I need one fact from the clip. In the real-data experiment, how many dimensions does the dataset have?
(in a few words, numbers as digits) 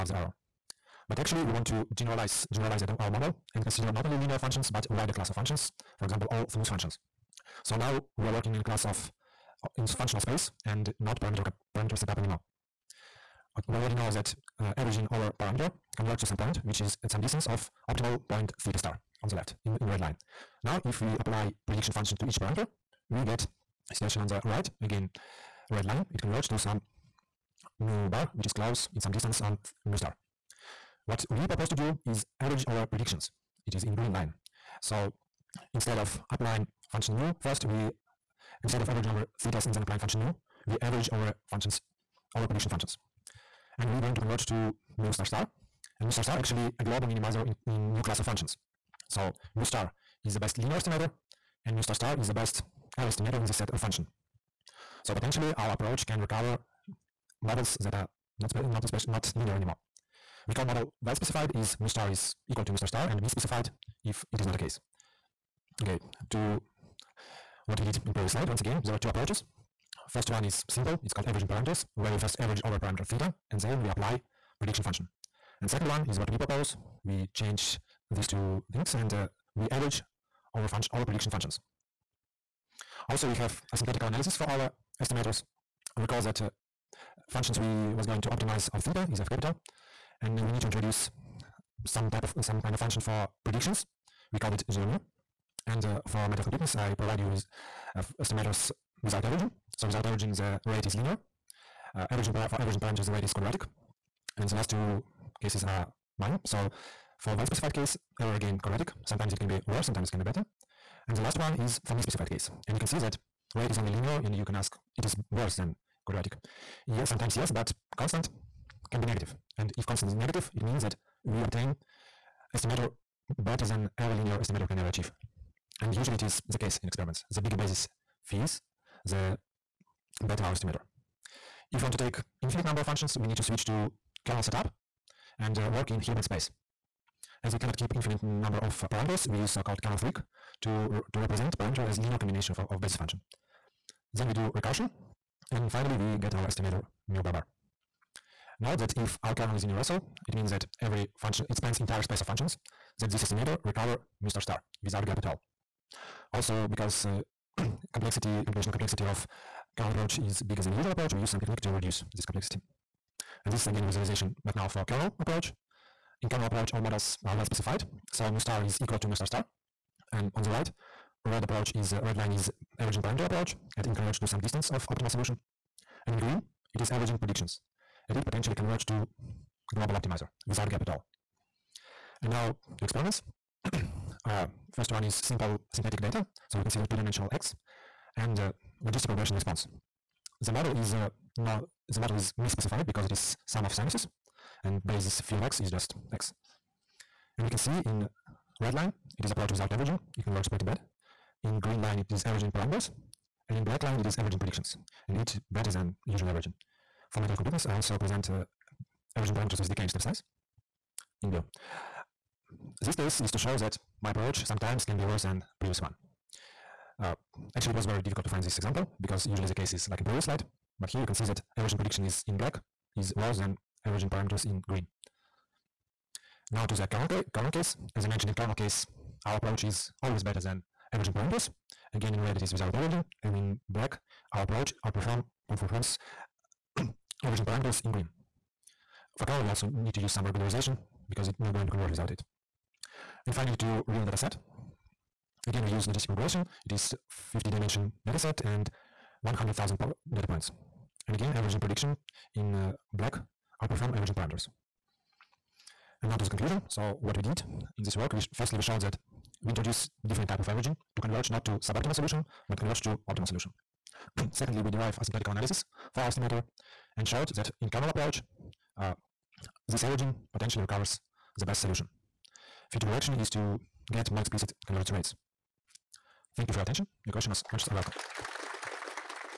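50.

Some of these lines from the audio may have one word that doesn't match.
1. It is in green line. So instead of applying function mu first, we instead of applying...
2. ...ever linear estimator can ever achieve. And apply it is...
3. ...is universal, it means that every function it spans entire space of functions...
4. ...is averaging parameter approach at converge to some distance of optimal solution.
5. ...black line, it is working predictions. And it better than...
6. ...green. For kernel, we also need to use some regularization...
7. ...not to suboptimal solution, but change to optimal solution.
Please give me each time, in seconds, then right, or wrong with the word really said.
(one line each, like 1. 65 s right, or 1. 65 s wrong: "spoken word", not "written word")
1. 33 s wrong: "averaging", not "applying"
2. 123 s wrong: "usually", not "apply"
3. 149 s right
4. 172 s right
5. 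203 s wrong: "averaging", not "working"
6. 237 s right
7. 261 s wrong: "converge", not "change".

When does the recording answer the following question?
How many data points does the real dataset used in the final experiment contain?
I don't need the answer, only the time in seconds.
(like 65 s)
249 s.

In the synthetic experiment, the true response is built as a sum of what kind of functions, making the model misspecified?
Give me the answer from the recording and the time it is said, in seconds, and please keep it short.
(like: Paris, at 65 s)
sinuses, at 193 s.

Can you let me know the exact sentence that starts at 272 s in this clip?
Future direction is to get more explicit convergence rates.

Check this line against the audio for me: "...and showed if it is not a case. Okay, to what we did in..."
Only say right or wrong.
wrong.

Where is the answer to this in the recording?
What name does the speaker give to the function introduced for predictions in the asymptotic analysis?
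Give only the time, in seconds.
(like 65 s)
94 s.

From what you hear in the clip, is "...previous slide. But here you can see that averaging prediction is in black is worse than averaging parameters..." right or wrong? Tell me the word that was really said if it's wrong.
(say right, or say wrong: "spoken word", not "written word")
right.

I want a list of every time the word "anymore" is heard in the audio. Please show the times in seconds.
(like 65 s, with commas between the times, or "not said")
12 s, 59 s.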